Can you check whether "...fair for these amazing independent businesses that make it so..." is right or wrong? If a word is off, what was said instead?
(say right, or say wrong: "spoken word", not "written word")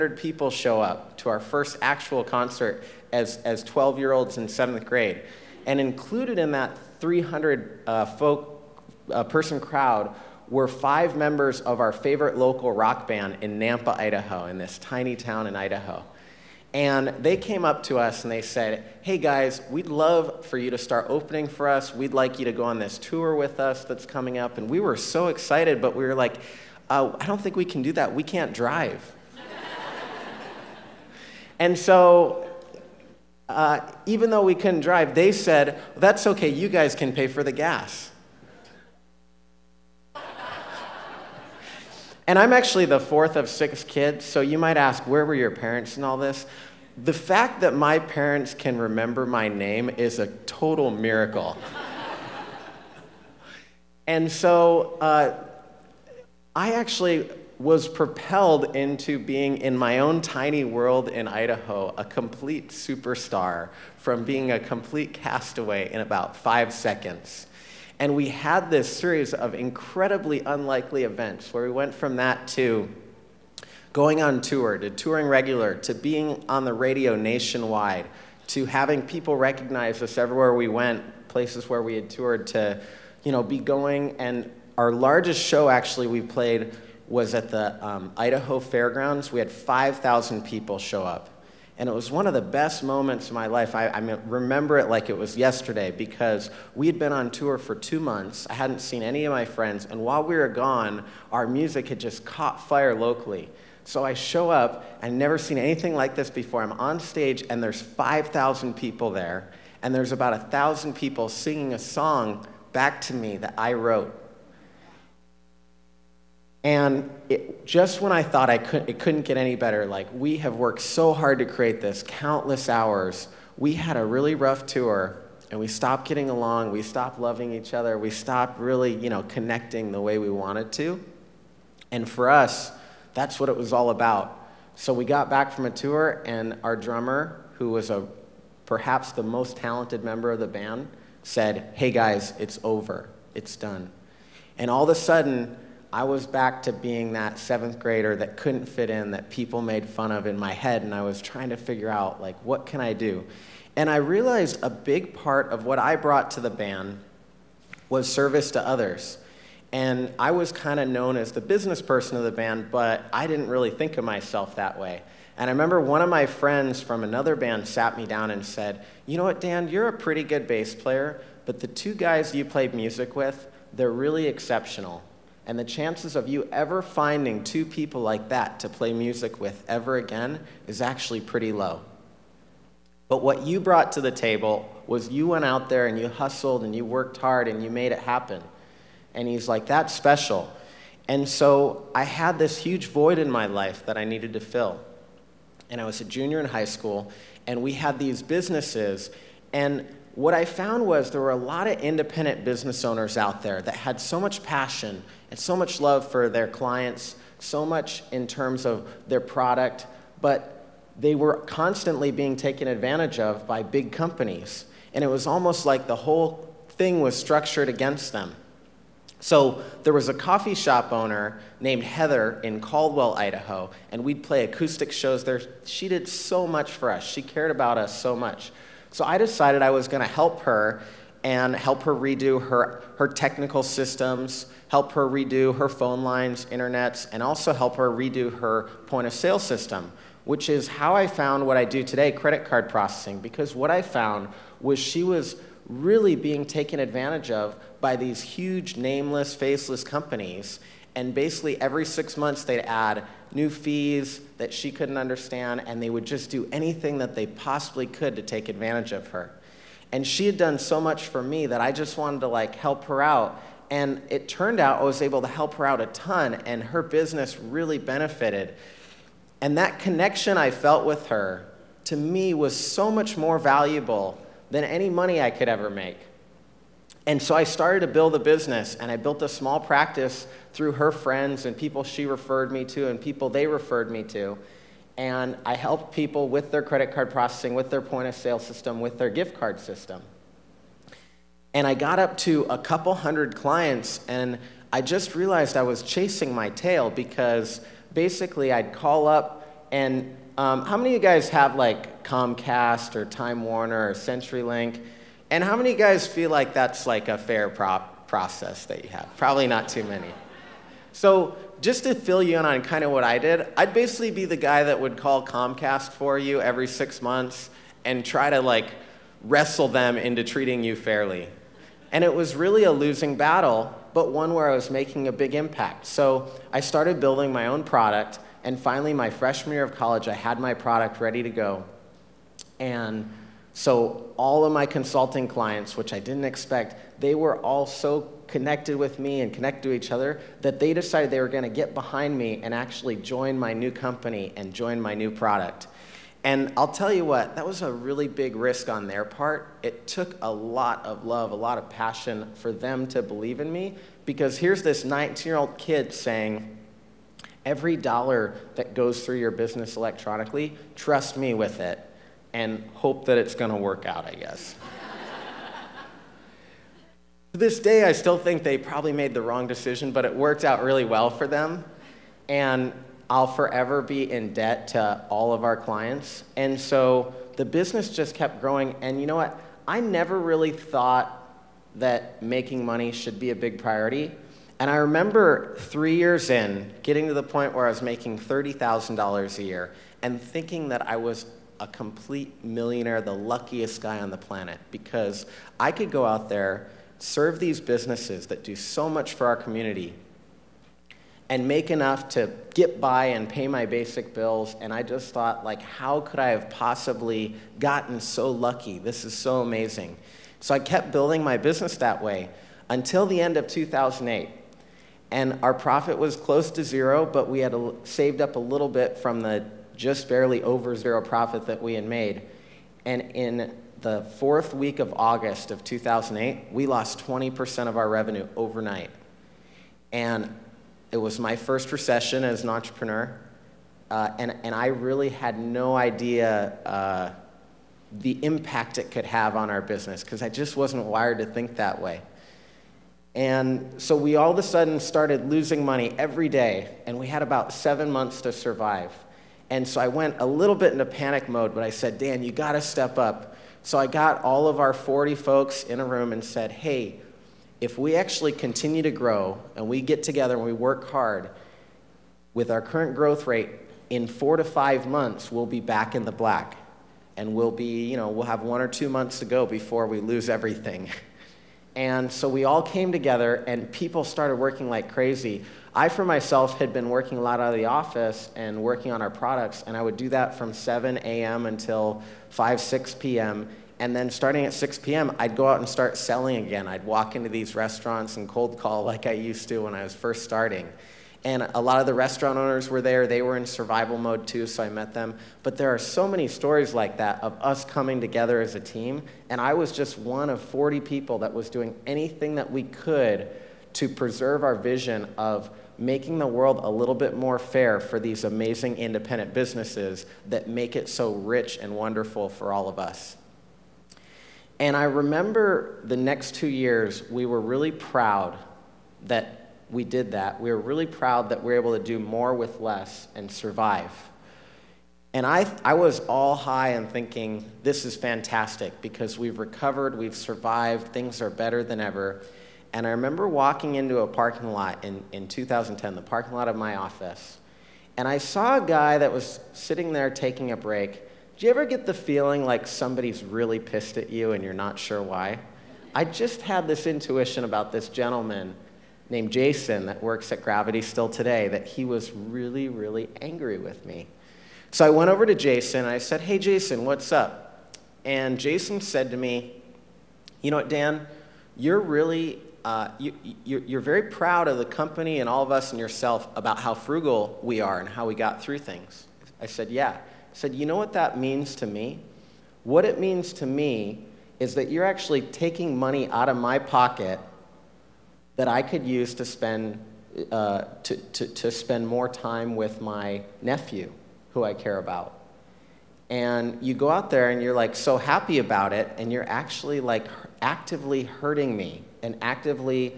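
right.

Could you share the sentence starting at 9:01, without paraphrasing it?
Do you ever get the feeling like somebody's really pissed at you and you're not sure why?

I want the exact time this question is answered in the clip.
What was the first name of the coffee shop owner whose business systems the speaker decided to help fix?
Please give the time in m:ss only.
3:41.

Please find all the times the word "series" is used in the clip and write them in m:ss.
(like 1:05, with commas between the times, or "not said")
1:08.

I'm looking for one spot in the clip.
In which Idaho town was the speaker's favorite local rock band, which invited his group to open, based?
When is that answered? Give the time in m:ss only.
0:13.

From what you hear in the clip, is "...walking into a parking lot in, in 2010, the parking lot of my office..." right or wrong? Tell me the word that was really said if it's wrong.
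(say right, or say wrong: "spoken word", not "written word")
right.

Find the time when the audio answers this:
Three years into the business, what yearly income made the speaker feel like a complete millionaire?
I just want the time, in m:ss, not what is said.
6:28.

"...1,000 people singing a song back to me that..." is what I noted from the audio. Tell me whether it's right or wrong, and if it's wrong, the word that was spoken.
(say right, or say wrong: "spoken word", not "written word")
right.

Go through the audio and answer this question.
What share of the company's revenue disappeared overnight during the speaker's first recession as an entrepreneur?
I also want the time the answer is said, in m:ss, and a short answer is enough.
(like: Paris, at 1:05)
20%, at 7:07.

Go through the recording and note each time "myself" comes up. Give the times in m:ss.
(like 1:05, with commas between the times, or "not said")
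2:44, 7:56.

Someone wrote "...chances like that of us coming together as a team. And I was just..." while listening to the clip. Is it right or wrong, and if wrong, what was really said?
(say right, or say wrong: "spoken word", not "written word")
wrong: "stories", not "chances".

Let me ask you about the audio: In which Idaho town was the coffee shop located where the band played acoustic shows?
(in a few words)
Caldwell.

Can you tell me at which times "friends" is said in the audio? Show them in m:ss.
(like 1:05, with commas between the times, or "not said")
1:39, 2:46, 4:40.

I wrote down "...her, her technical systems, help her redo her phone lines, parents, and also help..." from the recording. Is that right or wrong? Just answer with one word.
wrong.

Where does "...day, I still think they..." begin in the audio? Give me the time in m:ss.
6:07.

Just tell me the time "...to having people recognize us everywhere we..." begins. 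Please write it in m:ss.
1:18.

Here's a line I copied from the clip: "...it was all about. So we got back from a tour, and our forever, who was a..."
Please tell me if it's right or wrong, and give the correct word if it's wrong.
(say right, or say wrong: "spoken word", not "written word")
wrong: "drummer", not "forever".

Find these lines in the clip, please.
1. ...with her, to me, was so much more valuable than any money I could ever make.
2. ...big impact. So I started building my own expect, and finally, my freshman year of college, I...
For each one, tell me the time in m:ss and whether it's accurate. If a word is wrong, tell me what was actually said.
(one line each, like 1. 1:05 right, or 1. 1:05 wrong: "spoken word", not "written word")
1. 4:30 right
2. 5:25 wrong: "product", not "expect".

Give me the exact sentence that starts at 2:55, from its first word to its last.
And the chances of you ever finding two people like that to play music with ever again is actually pretty low.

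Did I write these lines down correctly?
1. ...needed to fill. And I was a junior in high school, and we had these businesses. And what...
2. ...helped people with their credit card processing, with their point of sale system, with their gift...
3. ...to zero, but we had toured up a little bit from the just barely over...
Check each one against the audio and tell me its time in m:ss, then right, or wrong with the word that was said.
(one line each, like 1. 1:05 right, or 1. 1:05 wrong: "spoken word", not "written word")
1. 3:14 right
2. 4:45 right
3. 6:56 wrong: "saved", not "toured".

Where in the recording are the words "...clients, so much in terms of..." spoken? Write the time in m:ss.
3:26.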